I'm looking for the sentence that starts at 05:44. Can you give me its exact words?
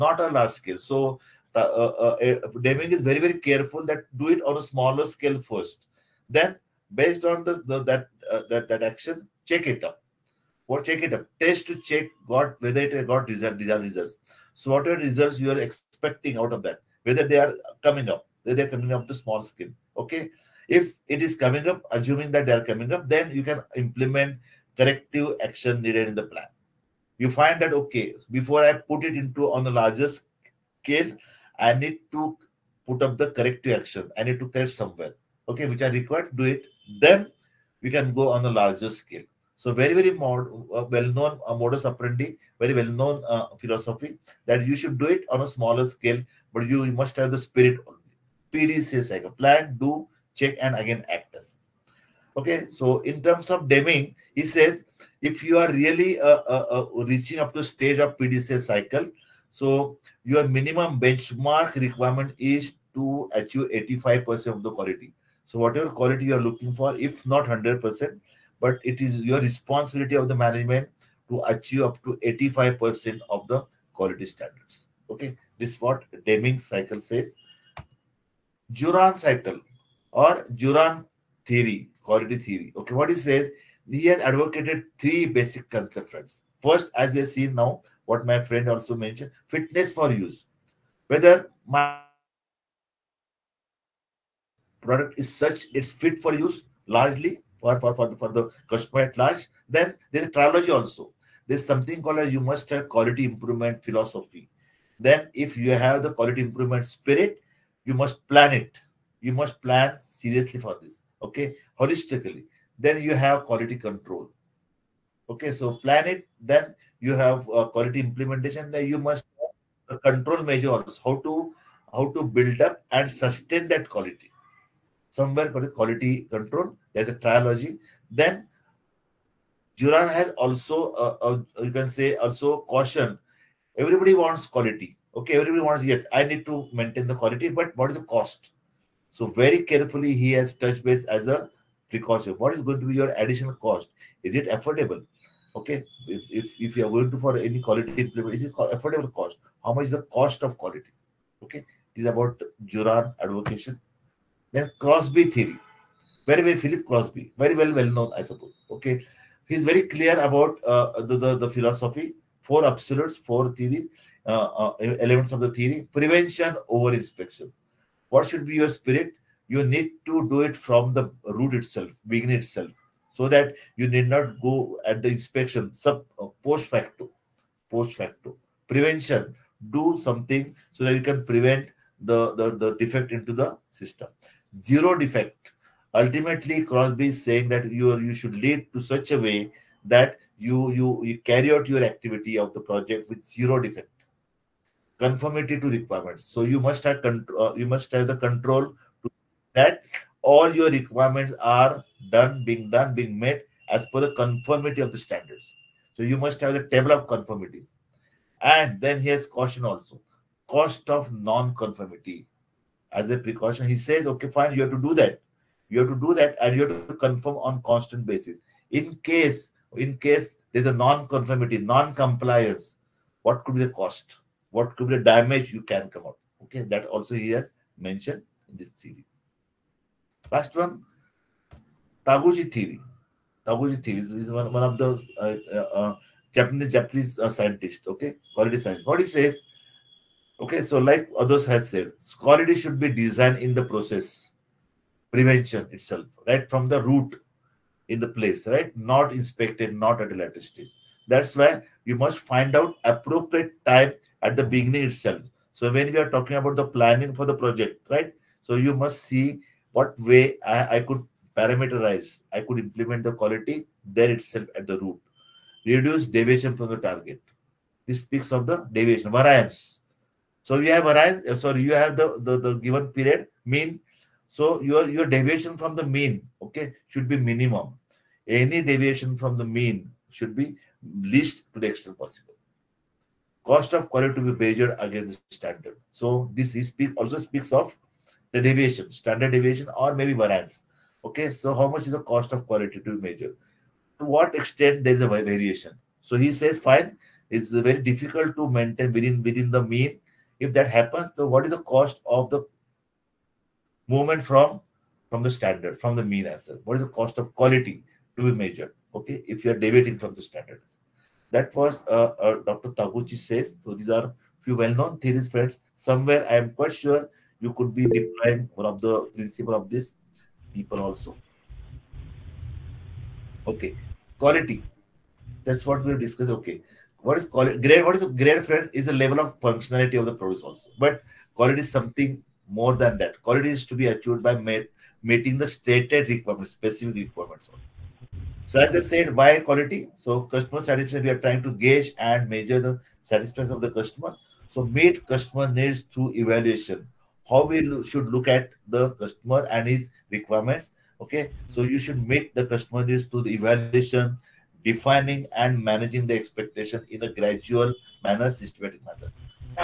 So meet customer needs through evaluation.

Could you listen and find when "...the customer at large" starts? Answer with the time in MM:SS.
01:38.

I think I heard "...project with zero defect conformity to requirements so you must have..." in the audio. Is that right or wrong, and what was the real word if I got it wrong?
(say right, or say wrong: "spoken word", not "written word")
right.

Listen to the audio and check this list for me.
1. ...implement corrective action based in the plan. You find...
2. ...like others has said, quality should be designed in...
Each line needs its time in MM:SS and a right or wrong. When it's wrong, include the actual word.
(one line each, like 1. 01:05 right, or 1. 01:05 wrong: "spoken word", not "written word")
1. 00:23 wrong: "needed", not "based"
2. 04:00 right.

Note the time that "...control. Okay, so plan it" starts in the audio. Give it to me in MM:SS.
01:53.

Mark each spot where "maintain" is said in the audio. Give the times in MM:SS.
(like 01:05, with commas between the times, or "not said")
02:16, 04:58.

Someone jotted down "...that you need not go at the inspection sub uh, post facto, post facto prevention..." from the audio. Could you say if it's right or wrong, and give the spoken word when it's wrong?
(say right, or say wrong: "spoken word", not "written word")
right.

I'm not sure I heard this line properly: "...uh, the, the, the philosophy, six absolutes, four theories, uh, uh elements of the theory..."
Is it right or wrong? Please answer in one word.
wrong.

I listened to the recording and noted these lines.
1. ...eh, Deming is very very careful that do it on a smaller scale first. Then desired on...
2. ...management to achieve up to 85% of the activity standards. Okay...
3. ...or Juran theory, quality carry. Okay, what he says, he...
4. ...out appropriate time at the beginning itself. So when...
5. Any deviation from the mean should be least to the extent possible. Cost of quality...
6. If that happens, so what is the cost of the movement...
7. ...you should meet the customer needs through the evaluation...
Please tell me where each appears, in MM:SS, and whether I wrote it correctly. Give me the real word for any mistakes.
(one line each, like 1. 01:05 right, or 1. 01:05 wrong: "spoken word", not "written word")
1. 00:02 wrong: "based", not "desired"
2. 01:10 wrong: "quality", not "activity"
3. 01:20 wrong: "theory", not "carry"
4. 04:12 right
5. 04:38 right
6. 05:00 right
7. 05:51 right.